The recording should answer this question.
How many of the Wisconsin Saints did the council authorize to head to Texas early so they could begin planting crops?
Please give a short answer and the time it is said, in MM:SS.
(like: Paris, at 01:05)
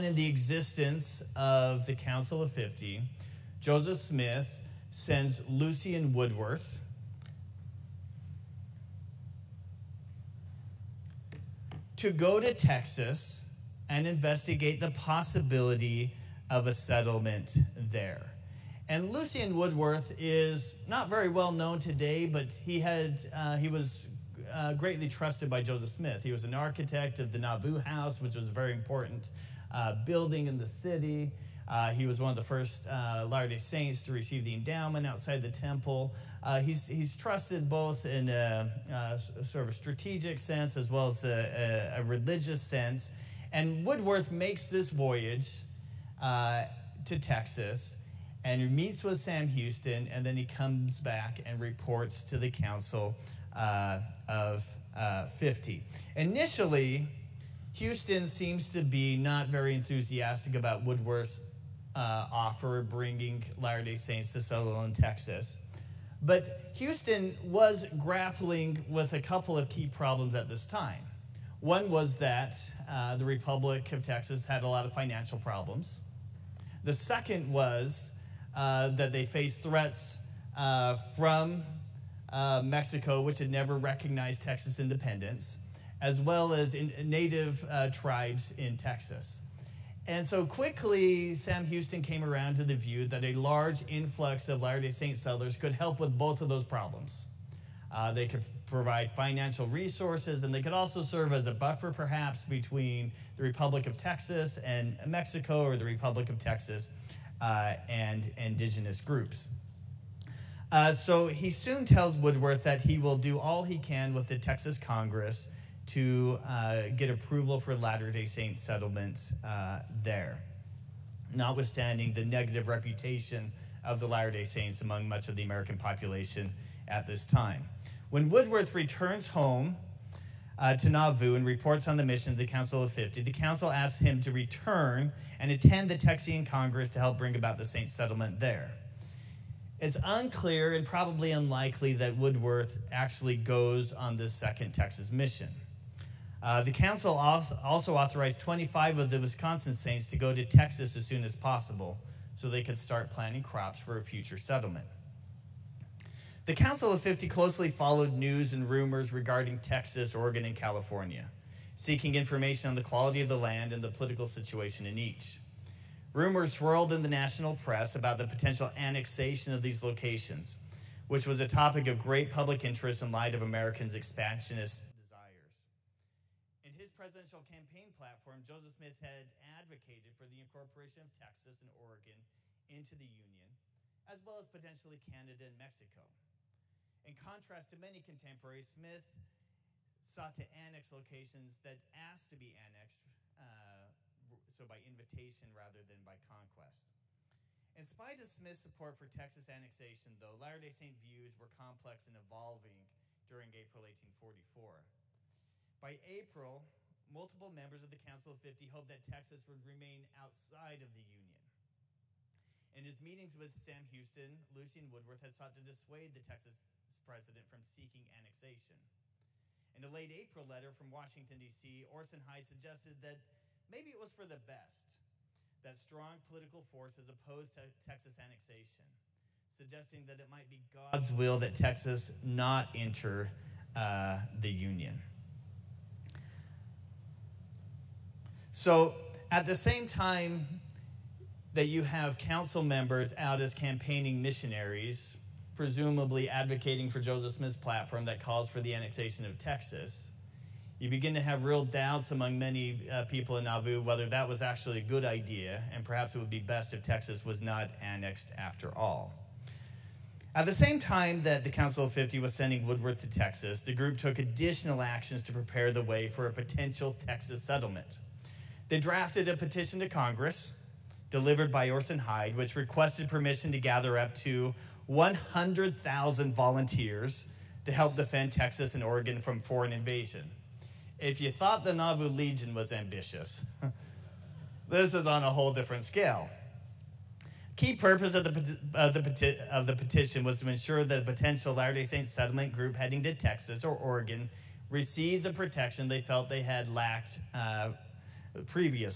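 25, at 02:28.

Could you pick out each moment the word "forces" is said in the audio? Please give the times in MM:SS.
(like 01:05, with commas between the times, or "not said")
03:46.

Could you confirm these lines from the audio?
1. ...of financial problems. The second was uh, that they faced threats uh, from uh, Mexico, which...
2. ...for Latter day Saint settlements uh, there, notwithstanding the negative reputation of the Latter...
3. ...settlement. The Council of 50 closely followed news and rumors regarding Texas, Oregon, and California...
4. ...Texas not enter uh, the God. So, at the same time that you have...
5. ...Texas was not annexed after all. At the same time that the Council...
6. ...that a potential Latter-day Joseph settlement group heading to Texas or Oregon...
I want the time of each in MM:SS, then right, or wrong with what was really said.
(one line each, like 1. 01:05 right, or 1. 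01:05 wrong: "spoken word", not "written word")
1. 01:14 right
2. 01:57 right
3. 02:34 right
4. 03:51 wrong: "Union", not "God"
5. 04:16 right
6. 04:50 wrong: "Saint", not "Joseph".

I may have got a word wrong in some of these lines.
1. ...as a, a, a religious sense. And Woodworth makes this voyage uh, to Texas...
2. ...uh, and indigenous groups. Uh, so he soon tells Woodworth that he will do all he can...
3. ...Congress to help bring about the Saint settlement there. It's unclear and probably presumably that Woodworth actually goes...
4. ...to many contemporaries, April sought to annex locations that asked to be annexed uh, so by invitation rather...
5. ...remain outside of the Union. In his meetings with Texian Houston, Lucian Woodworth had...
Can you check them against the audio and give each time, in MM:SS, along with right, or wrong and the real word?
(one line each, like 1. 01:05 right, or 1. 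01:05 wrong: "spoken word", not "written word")
1. 00:41 right
2. 01:47 right
3. 02:16 wrong: "unlikely", not "presumably"
4. 03:07 wrong: "Smith", not "April"
5. 03:29 wrong: "Sam", not "Texian".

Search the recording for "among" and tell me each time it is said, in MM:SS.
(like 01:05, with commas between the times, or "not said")
02:04, 04:12.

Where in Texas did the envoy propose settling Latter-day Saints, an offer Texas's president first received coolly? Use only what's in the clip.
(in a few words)
Sutherland, Texas.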